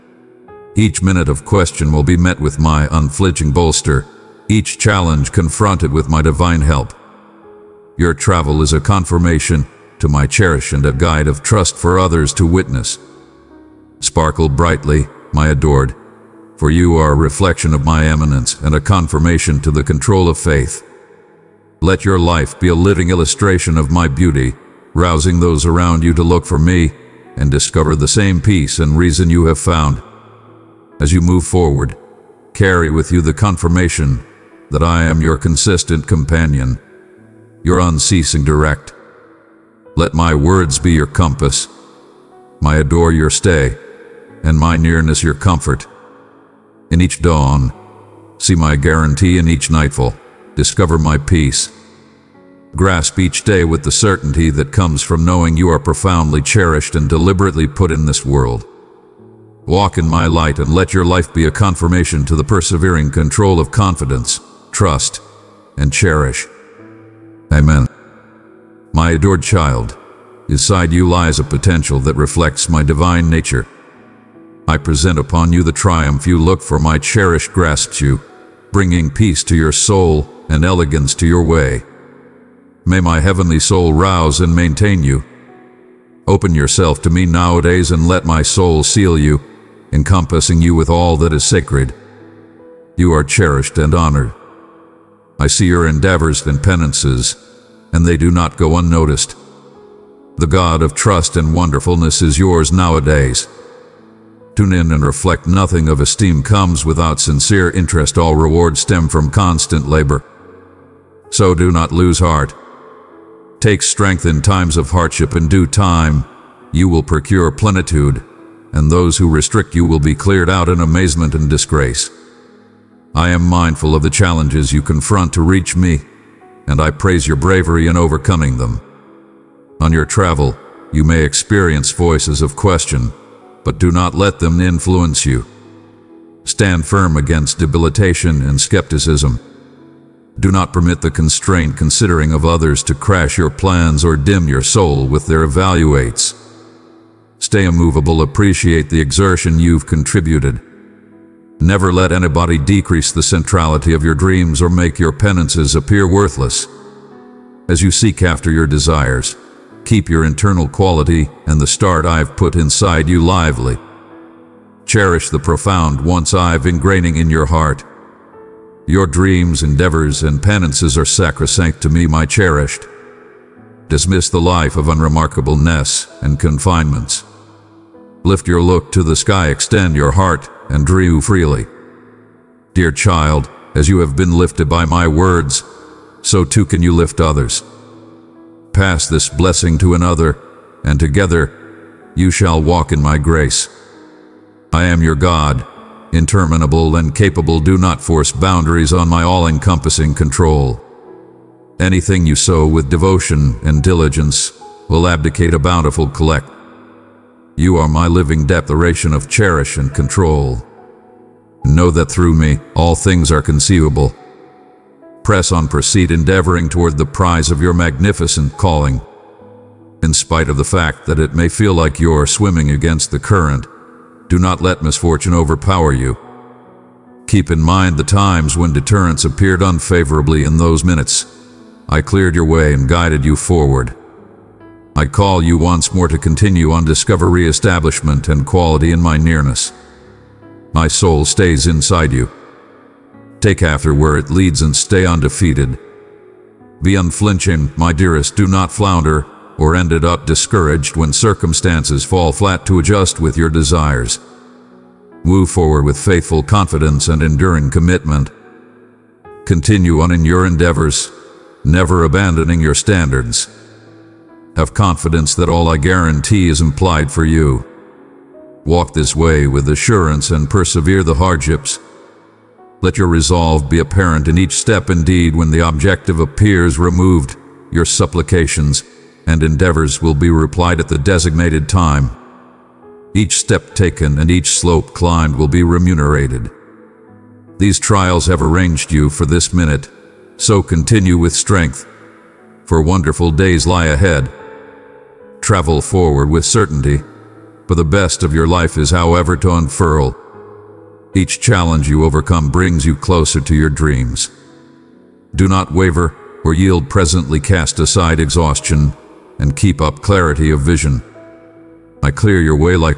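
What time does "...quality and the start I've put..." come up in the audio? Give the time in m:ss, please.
2:40.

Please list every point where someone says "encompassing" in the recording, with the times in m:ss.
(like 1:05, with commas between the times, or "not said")
1:29, 3:19.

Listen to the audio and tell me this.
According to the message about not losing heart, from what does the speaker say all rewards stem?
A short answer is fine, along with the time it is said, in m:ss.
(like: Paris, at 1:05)
constant labor, at 1:49.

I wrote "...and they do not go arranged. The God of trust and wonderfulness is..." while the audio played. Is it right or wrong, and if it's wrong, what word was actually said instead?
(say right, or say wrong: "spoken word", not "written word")
wrong: "unnoticed", not "arranged".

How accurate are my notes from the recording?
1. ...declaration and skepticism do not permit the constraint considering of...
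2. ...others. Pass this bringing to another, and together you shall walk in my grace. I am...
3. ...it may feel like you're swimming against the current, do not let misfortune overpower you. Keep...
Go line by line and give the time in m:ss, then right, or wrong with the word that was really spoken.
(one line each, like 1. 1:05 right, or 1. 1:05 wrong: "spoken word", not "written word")
1. 2:17 wrong: "debilitation", not "declaration"
2. 3:07 wrong: "blessing", not "bringing"
3. 3:41 right.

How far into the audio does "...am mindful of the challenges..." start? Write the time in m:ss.
2:03.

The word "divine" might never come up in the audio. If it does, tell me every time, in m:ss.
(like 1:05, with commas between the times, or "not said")
0:06, 1:12.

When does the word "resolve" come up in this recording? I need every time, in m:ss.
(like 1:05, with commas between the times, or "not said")
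4:33.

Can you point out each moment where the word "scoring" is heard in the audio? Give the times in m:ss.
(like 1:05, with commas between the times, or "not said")
not said.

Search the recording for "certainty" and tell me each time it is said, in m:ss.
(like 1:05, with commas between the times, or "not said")
0:53, 4:56.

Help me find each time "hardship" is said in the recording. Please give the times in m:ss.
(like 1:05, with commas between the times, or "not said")
1:54, 4:31.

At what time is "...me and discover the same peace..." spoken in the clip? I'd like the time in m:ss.
0:26.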